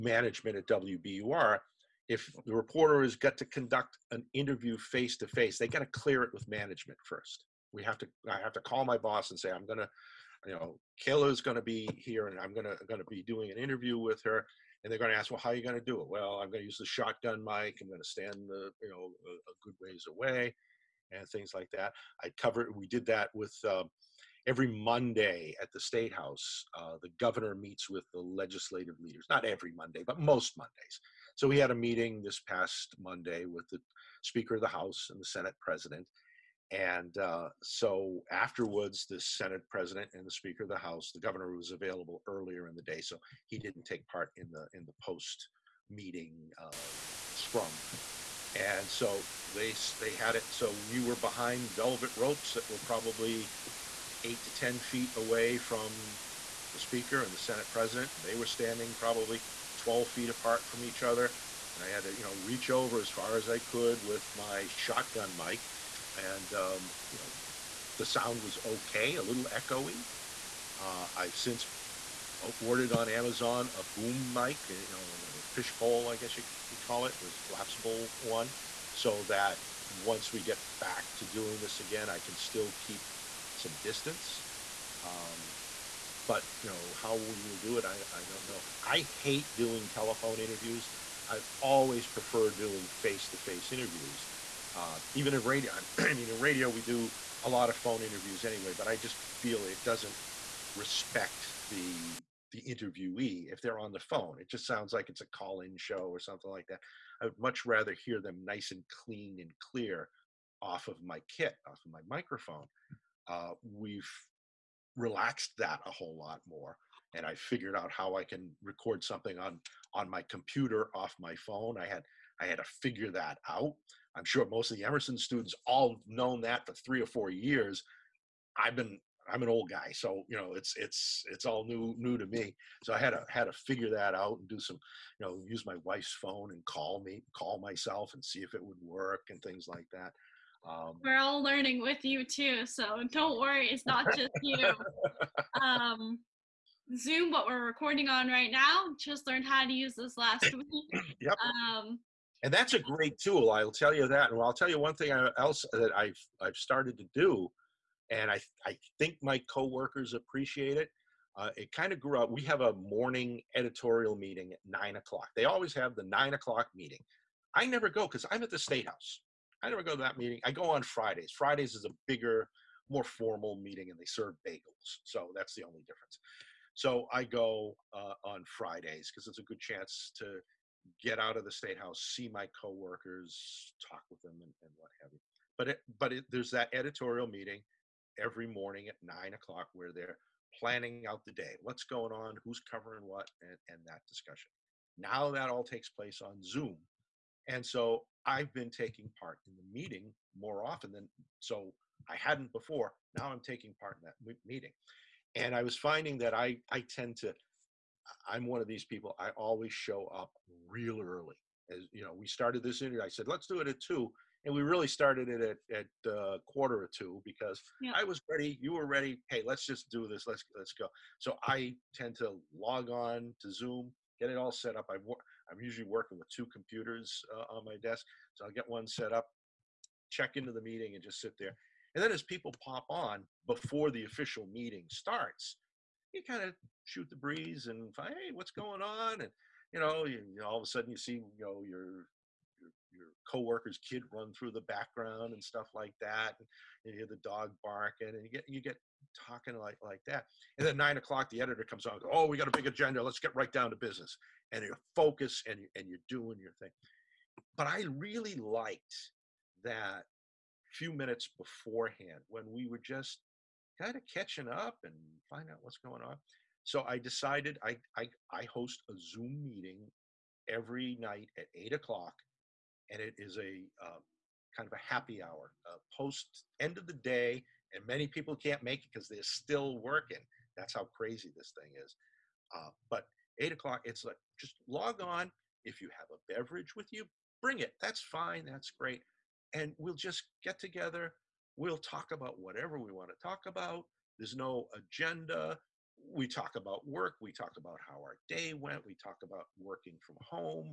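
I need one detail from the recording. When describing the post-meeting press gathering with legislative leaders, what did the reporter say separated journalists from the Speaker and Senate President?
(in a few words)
velvet ropes.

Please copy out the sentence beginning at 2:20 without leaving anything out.
Um, We're all learning with you too, so don't worry, it's not just you.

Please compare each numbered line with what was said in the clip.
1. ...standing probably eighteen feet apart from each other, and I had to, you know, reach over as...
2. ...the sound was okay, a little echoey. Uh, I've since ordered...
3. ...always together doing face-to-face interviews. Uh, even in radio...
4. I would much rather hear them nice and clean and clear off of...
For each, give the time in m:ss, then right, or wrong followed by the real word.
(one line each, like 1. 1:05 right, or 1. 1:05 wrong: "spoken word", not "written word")
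1. 0:58 wrong: "twelve", not "eighteen"
2. 1:07 right
3. 1:31 wrong: "prefer", not "together"
4. 1:47 right.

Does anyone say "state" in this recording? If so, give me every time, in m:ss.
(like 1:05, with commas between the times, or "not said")
0:25, 2:48, 3:01.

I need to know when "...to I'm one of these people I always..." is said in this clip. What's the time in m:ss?
3:27.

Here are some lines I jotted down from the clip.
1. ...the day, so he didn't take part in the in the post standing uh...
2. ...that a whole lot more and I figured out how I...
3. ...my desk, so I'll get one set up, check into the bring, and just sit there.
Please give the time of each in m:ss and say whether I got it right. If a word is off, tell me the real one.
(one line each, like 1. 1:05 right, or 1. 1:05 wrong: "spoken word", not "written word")
1. 0:42 wrong: "meeting", not "standing"
2. 1:55 right
3. 3:47 wrong: "meeting", not "bring".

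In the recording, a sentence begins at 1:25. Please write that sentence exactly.
Um, but you know how we will do it, I, I don't know.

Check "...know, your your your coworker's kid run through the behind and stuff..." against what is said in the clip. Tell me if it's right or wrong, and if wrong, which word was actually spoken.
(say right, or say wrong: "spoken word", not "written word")
wrong: "background", not "behind".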